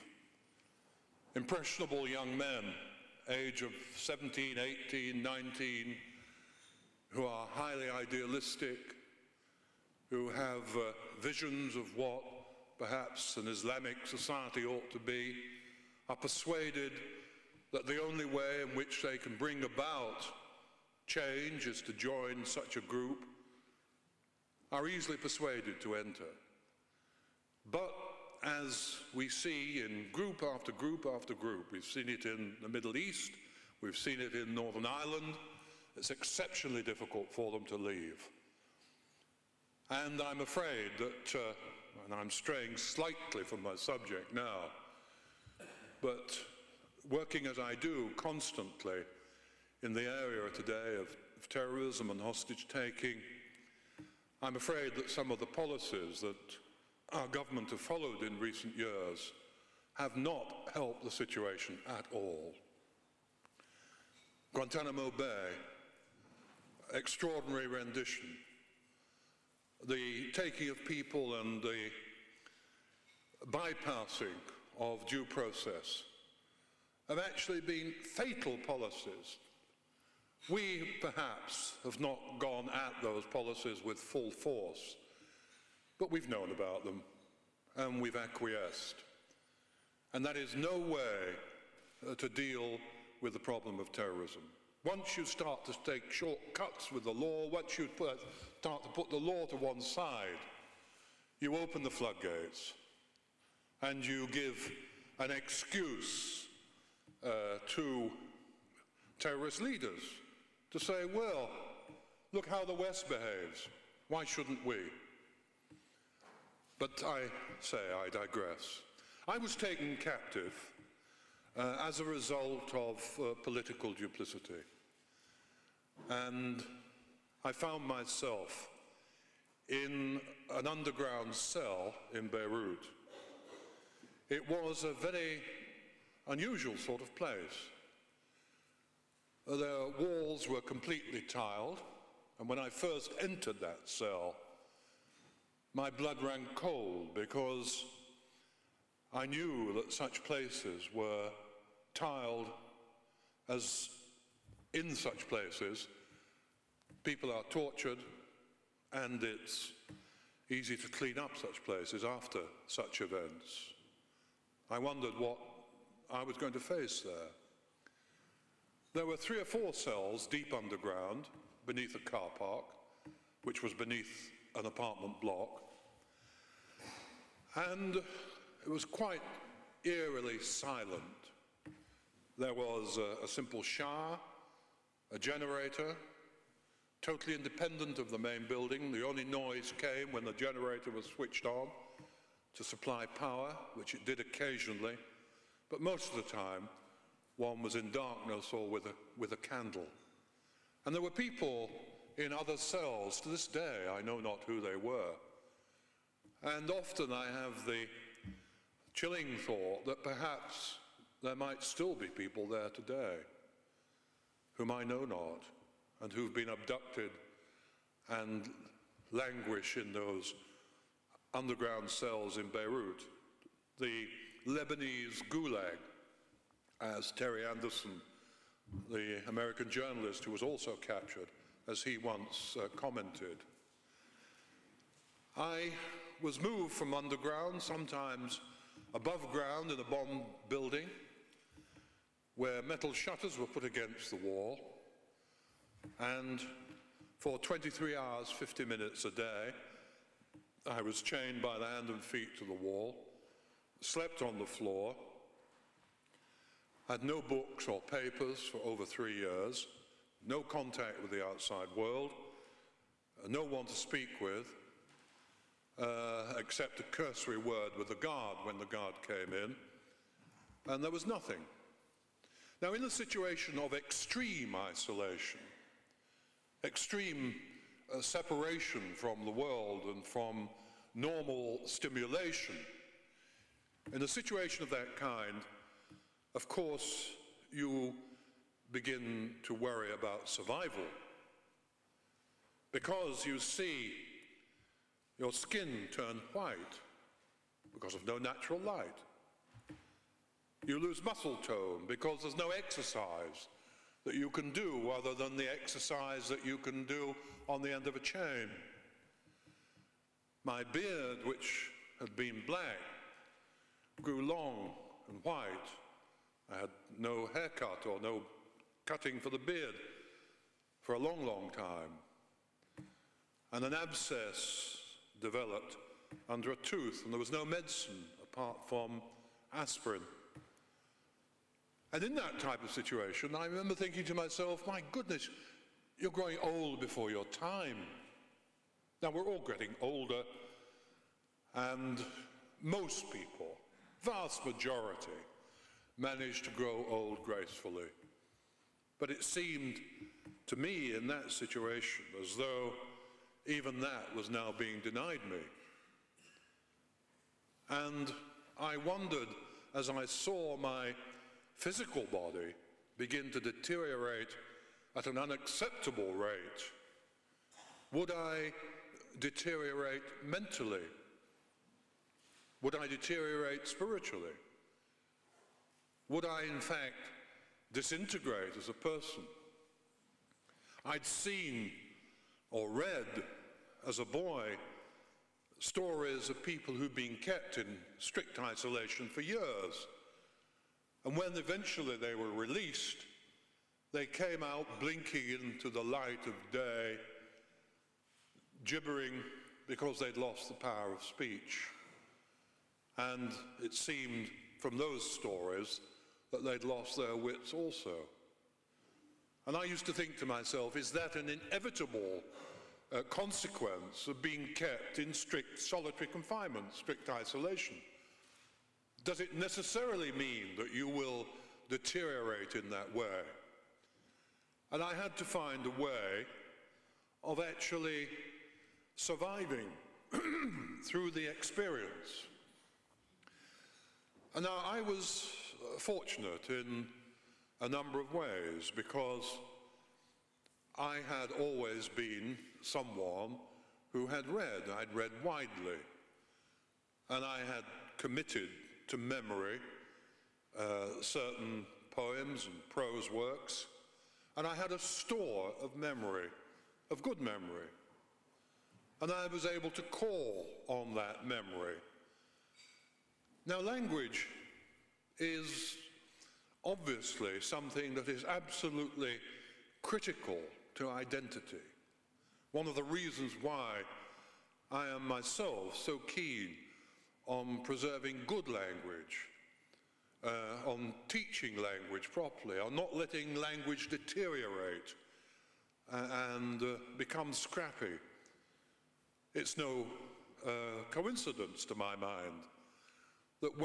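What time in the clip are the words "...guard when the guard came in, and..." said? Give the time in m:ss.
4:27.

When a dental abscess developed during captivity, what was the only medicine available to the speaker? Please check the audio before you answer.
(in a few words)
aspirin.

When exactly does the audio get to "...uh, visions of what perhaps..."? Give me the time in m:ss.
0:10.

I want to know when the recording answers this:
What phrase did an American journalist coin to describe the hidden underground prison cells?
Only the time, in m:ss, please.
3:43.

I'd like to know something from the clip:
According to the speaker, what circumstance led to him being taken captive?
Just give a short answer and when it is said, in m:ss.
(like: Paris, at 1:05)
political duplicity, at 2:03.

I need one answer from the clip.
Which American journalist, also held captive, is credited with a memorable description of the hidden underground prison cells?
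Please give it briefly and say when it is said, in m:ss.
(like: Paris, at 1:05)
Terry Anderson, at 3:47.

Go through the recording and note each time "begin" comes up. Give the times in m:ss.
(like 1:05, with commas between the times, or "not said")
4:48, 6:02.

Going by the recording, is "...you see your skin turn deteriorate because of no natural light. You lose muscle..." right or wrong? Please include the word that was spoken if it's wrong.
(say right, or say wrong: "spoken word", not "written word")
wrong: "white", not "deteriorate".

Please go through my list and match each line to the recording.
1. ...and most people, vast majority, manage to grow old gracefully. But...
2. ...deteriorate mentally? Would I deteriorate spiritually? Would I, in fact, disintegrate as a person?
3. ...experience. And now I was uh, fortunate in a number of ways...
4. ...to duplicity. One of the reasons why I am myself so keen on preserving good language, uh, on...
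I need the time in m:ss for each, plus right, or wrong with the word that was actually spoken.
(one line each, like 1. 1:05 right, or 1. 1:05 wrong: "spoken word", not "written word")
1. 5:41 right
2. 6:09 right
3. 7:11 right
4. 7:50 wrong: "identity", not "duplicity".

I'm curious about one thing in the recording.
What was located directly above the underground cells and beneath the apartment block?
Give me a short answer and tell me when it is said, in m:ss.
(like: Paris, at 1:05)
a car park, at 2:51.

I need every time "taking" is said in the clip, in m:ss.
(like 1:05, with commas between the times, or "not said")
0:52, 1:10.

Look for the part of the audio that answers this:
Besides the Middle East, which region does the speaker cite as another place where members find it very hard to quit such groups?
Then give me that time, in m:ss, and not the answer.
0:34.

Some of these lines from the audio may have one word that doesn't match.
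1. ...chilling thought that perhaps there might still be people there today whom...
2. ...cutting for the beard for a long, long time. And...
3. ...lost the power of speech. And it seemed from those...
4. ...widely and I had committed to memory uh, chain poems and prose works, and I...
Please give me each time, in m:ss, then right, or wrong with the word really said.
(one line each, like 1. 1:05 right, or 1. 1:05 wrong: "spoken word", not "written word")
1. 3:28 right
2. 5:18 right
3. 6:40 right
4. 7:25 wrong: "certain", not "chain".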